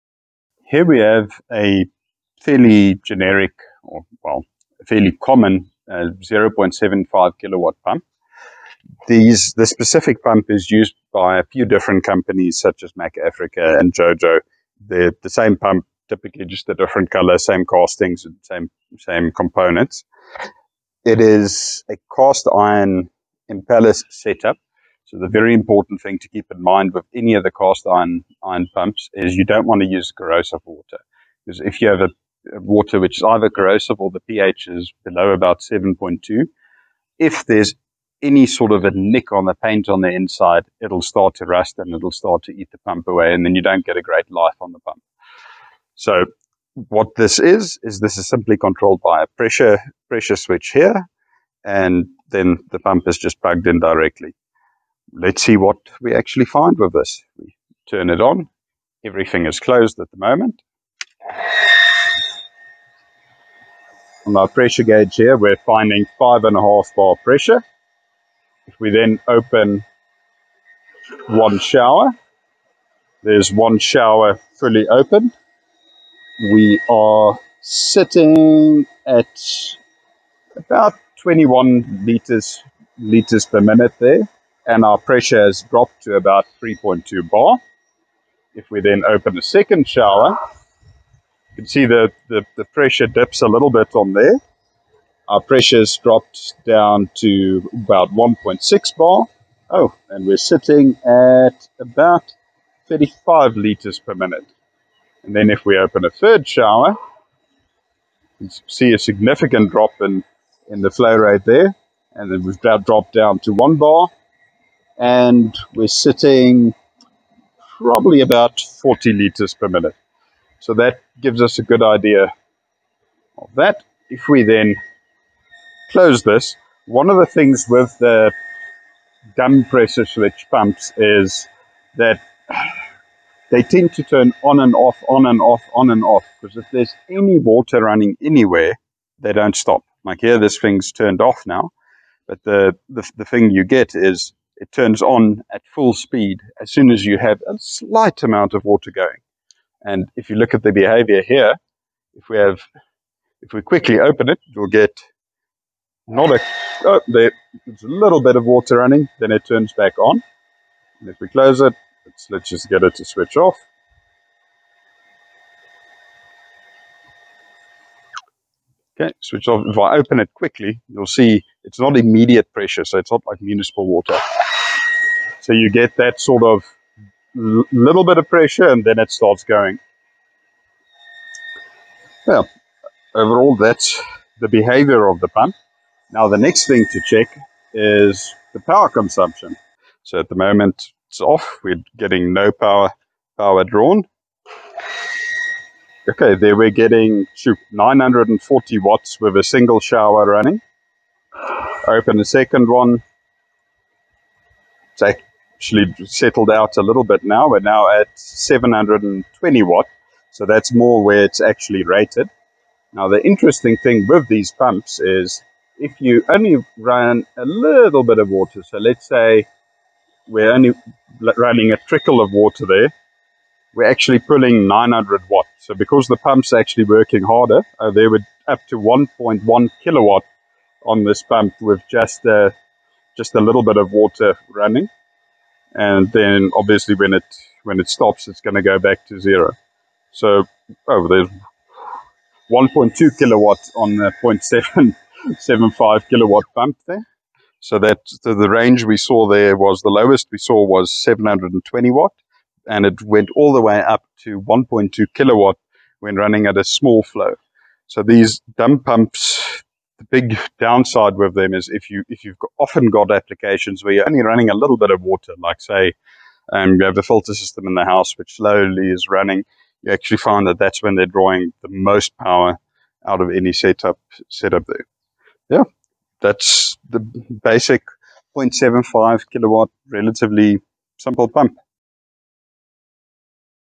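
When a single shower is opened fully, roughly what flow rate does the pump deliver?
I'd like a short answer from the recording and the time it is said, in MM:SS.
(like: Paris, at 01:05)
21 liters per minute, at 01:21.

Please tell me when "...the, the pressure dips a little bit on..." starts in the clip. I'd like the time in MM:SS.
01:32.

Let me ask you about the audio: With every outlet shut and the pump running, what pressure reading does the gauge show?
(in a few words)
5.5 bar.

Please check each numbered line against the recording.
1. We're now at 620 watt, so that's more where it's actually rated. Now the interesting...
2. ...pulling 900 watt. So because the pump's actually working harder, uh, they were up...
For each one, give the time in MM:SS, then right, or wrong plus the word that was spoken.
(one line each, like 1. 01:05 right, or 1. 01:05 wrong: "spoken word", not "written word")
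1. 03:27 wrong: "720", not "620"
2. 03:44 right.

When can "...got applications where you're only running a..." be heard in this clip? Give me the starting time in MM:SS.
04:22.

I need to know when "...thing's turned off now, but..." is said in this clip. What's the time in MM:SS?
02:20.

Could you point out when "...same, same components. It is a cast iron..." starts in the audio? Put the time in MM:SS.
00:18.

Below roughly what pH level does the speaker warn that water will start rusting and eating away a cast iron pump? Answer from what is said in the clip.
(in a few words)
7.2.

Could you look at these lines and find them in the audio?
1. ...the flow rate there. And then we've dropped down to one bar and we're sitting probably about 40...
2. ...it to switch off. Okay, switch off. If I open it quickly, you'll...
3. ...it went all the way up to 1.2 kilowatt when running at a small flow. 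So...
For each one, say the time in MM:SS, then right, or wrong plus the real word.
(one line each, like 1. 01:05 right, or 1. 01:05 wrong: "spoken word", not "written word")
1. 01:50 right
2. 02:42 right
3. 04:12 right.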